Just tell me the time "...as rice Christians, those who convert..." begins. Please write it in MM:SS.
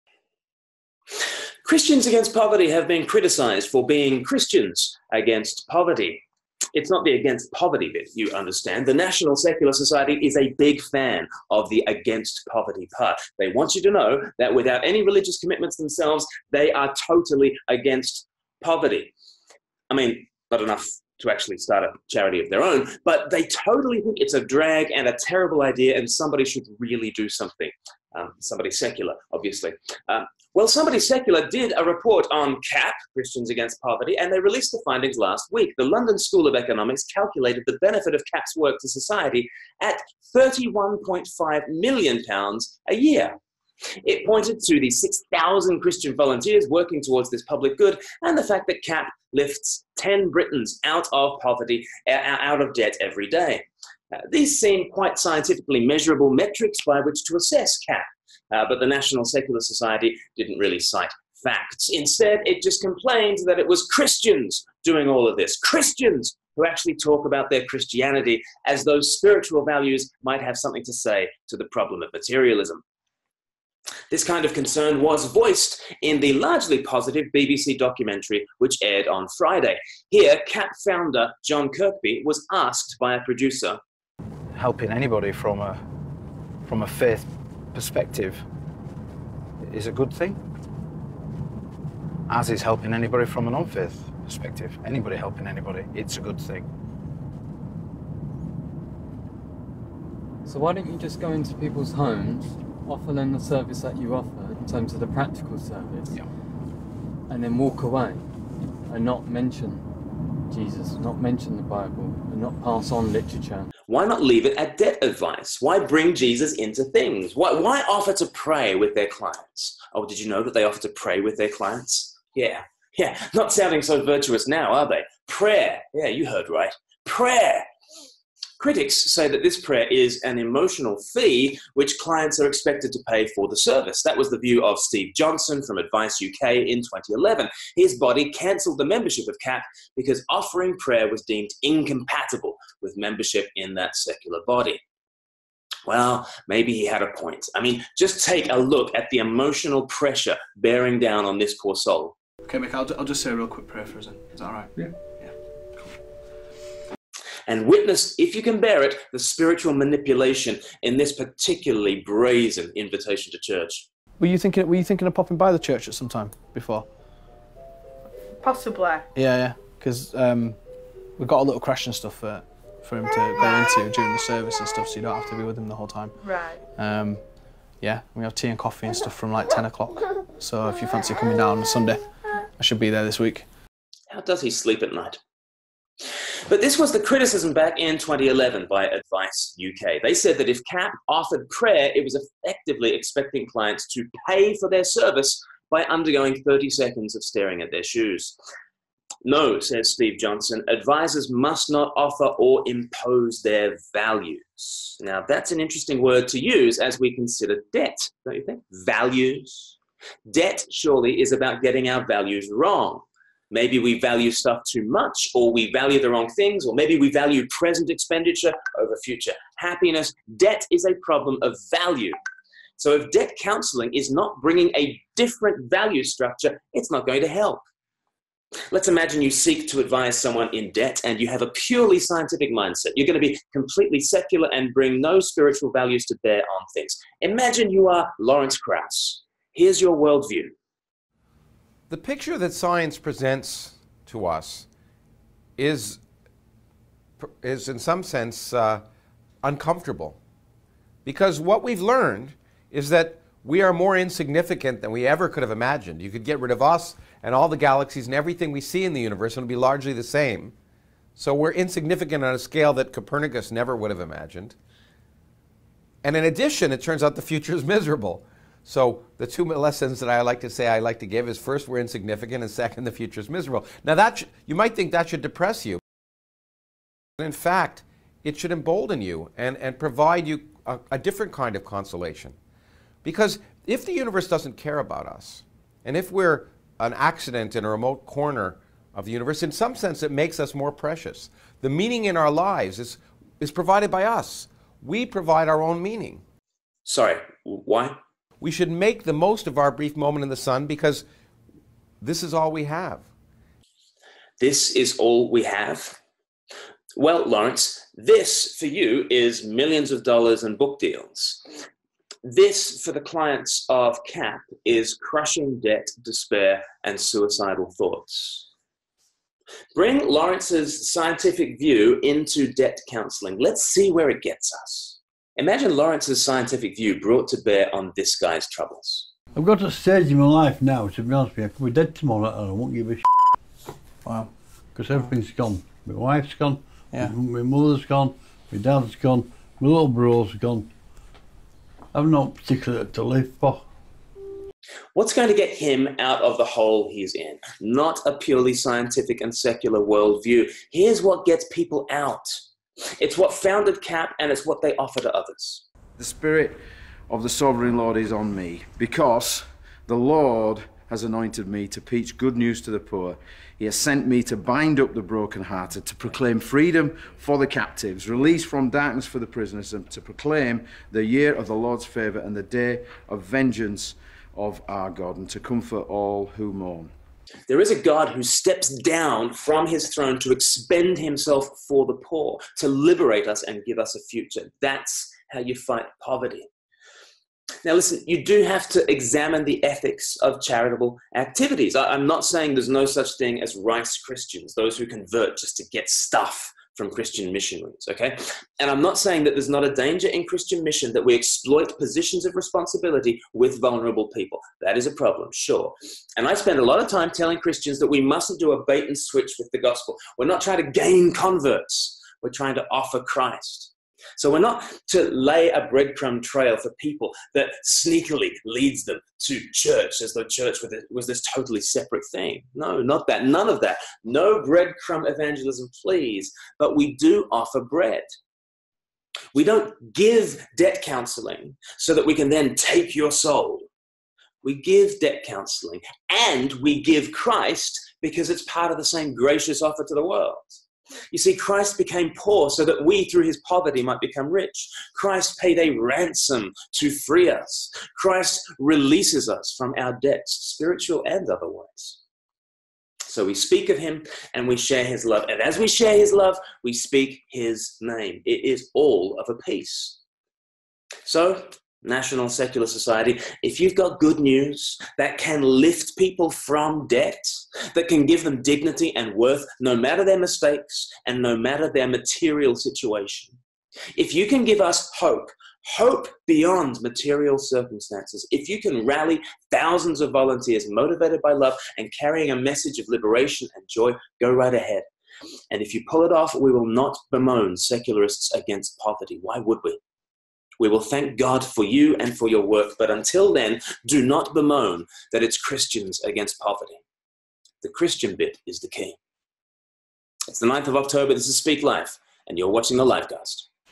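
06:33.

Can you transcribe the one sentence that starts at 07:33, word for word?
So we speak of him and we share his love.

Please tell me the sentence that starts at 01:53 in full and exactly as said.
Why not leave it at debt advice?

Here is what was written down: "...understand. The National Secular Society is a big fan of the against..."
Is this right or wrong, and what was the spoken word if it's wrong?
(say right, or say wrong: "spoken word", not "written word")
right.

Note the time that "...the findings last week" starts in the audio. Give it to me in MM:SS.
00:34.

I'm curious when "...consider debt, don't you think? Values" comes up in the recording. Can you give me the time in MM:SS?
03:27.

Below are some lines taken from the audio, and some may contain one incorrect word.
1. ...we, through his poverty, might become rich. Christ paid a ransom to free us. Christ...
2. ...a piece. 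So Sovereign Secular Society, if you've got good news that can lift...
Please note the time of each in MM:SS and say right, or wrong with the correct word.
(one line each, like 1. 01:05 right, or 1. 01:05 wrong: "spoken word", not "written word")
1. 07:22 right
2. 07:39 wrong: "National", not "Sovereign".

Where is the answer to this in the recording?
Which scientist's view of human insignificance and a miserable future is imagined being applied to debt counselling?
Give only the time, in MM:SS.
03:58.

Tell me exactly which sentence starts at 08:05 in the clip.
And if you pull it off, we will not bemoan secularists against poverty.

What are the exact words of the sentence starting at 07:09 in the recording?
We don't give debt counseling so that we can then take your soul.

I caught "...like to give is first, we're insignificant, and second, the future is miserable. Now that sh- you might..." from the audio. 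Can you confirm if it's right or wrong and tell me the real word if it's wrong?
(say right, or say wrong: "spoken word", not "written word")
right.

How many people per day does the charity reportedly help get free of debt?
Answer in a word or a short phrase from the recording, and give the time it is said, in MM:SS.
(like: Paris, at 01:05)
10, at 00:49.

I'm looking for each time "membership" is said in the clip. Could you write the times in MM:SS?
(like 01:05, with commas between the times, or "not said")
02:18, 02:22.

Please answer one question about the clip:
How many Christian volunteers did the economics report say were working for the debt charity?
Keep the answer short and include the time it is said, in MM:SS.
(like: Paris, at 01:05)
6,000, at 00:44.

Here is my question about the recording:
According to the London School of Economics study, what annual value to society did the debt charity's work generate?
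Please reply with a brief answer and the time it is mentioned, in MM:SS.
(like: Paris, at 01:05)
£31.5 million, at 00:40.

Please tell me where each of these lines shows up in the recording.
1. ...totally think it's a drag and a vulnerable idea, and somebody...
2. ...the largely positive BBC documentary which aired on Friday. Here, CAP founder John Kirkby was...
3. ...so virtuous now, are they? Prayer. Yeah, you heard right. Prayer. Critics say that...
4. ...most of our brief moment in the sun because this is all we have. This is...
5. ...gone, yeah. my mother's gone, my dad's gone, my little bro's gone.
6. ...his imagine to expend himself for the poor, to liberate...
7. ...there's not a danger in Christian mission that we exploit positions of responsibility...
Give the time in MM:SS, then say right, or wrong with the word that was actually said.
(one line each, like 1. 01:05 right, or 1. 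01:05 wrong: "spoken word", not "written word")
1. 00:23 wrong: "terrible", not "vulnerable"
2. 01:16 right
3. 02:03 right
4. 04:59 right
5. 05:36 right
6. 06:19 wrong: "throne", not "imagine"
7. 06:39 right.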